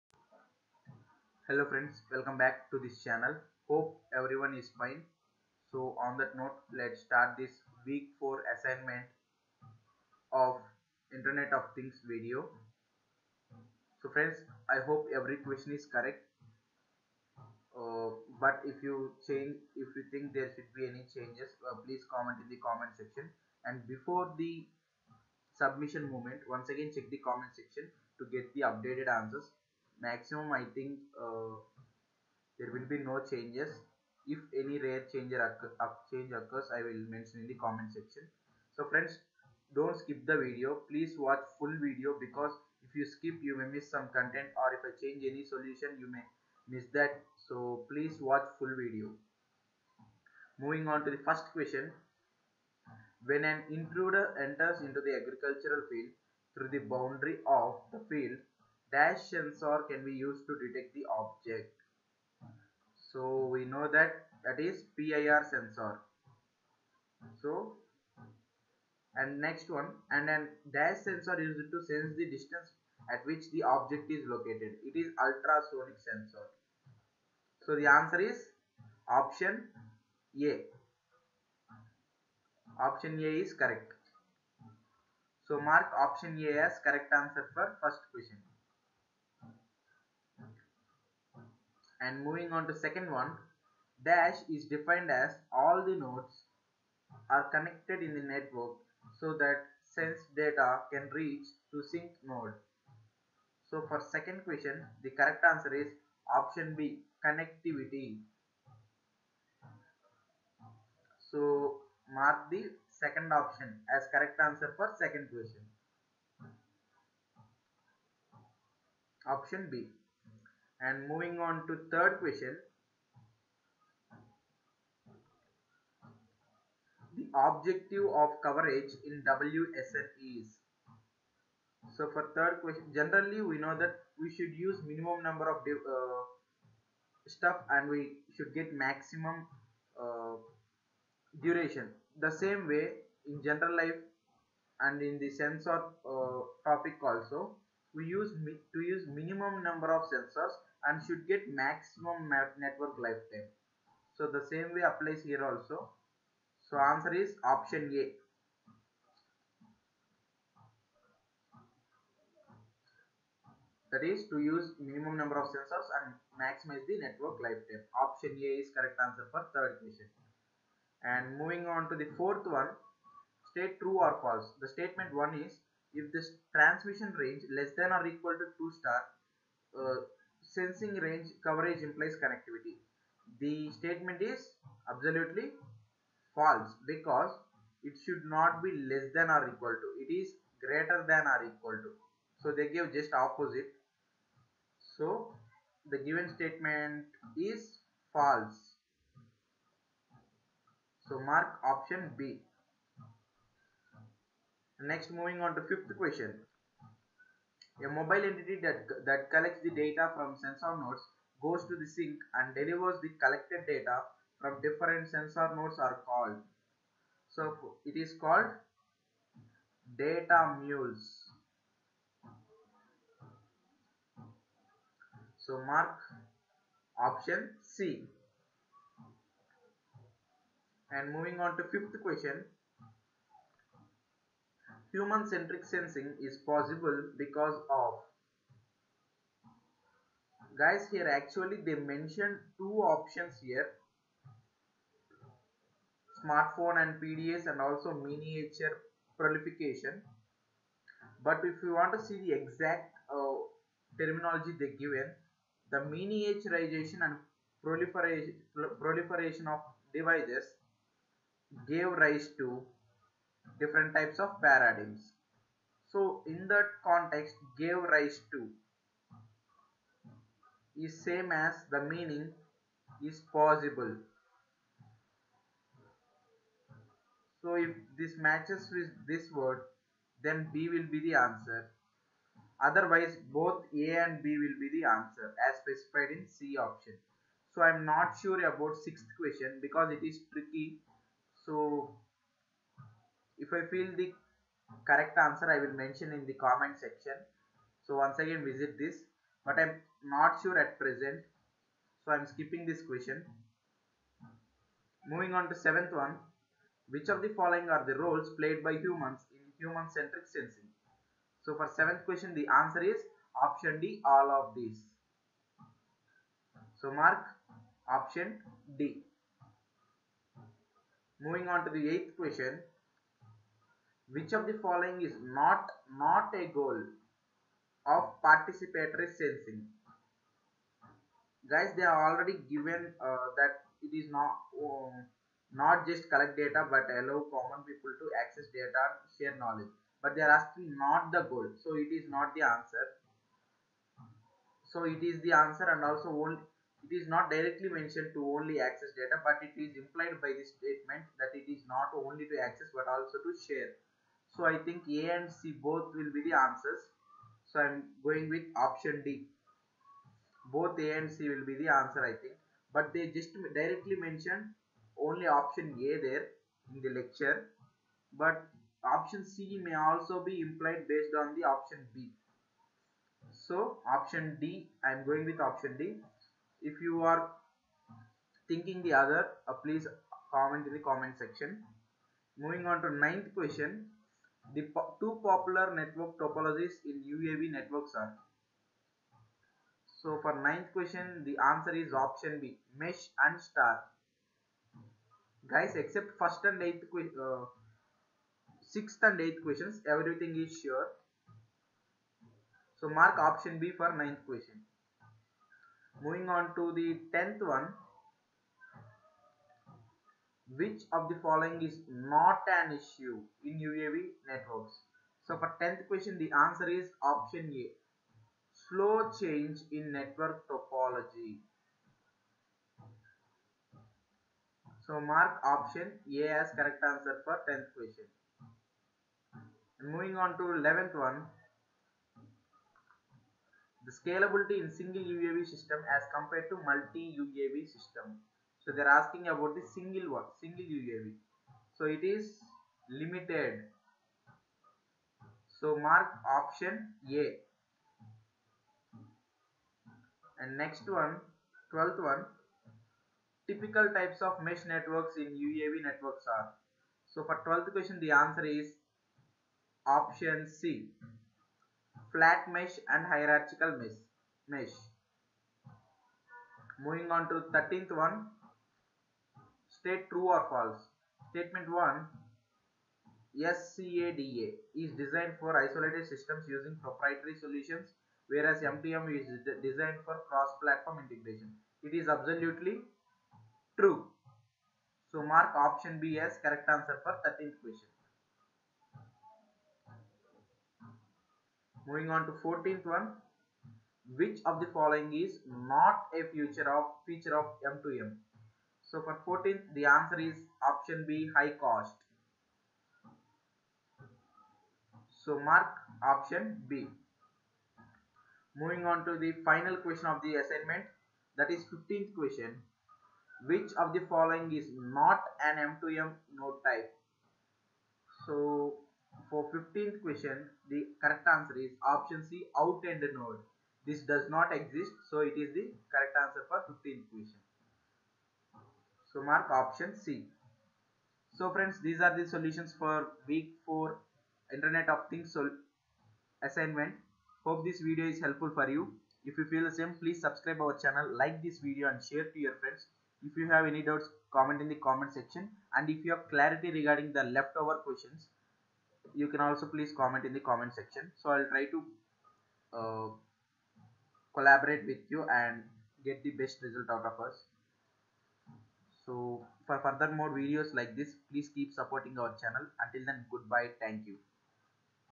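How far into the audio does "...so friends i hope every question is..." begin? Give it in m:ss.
0:14.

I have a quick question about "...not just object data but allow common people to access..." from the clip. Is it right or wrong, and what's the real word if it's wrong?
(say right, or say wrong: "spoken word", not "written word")
wrong: "collect", not "object".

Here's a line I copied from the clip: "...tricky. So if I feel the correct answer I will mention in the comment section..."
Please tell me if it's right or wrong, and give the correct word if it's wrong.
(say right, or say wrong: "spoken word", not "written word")
right.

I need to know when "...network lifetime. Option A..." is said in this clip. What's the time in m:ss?
2:46.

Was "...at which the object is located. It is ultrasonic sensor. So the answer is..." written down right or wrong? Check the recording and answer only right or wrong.
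right.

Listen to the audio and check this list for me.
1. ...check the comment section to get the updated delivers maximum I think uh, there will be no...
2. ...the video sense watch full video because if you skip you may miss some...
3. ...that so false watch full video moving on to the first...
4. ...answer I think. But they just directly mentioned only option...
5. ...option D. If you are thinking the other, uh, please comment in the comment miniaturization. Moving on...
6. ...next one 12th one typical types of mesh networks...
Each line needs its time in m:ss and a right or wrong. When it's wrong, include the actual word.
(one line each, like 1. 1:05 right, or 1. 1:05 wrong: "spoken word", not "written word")
1. 0:26 wrong: "answers", not "delivers"
2. 0:40 wrong: "please", not "sense"
3. 0:46 wrong: "please", not "false"
4. 6:01 right
5. 6:15 wrong: "section", not "miniaturization"
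6. 7:30 right.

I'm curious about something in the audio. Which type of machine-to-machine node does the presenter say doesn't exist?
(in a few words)
Out-end node.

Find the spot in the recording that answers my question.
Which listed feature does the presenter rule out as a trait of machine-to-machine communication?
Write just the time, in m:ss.
8:21.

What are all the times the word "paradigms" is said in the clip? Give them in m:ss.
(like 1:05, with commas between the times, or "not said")
4:24.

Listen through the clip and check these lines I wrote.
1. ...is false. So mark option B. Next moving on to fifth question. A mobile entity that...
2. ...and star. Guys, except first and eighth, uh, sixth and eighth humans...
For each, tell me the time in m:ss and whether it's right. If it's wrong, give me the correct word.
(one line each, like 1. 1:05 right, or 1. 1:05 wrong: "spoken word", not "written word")
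1. 3:17 right
2. 6:33 wrong: "questions", not "humans".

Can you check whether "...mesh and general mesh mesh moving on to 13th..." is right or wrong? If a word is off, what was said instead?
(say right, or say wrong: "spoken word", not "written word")
wrong: "hierarchical", not "general".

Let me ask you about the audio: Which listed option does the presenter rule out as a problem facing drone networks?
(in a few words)
Slow change in network topology.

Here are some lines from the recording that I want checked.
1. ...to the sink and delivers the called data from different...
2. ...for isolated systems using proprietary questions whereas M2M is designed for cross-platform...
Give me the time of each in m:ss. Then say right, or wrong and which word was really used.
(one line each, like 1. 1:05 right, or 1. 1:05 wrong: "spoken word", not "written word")
1. 3:31 wrong: "collected", not "called"
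2. 7:55 wrong: "solutions", not "questions".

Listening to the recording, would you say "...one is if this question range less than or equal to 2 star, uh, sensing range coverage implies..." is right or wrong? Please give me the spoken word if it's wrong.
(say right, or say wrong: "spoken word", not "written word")
wrong: "transmission", not "question".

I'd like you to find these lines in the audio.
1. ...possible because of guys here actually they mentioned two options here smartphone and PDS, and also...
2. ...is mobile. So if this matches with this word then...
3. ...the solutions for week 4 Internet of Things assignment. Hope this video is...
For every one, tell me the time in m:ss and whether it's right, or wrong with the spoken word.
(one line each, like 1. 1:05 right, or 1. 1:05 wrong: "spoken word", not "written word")
1. 3:56 right
2. 4:33 wrong: "possible", not "mobile"
3. 8:52 right.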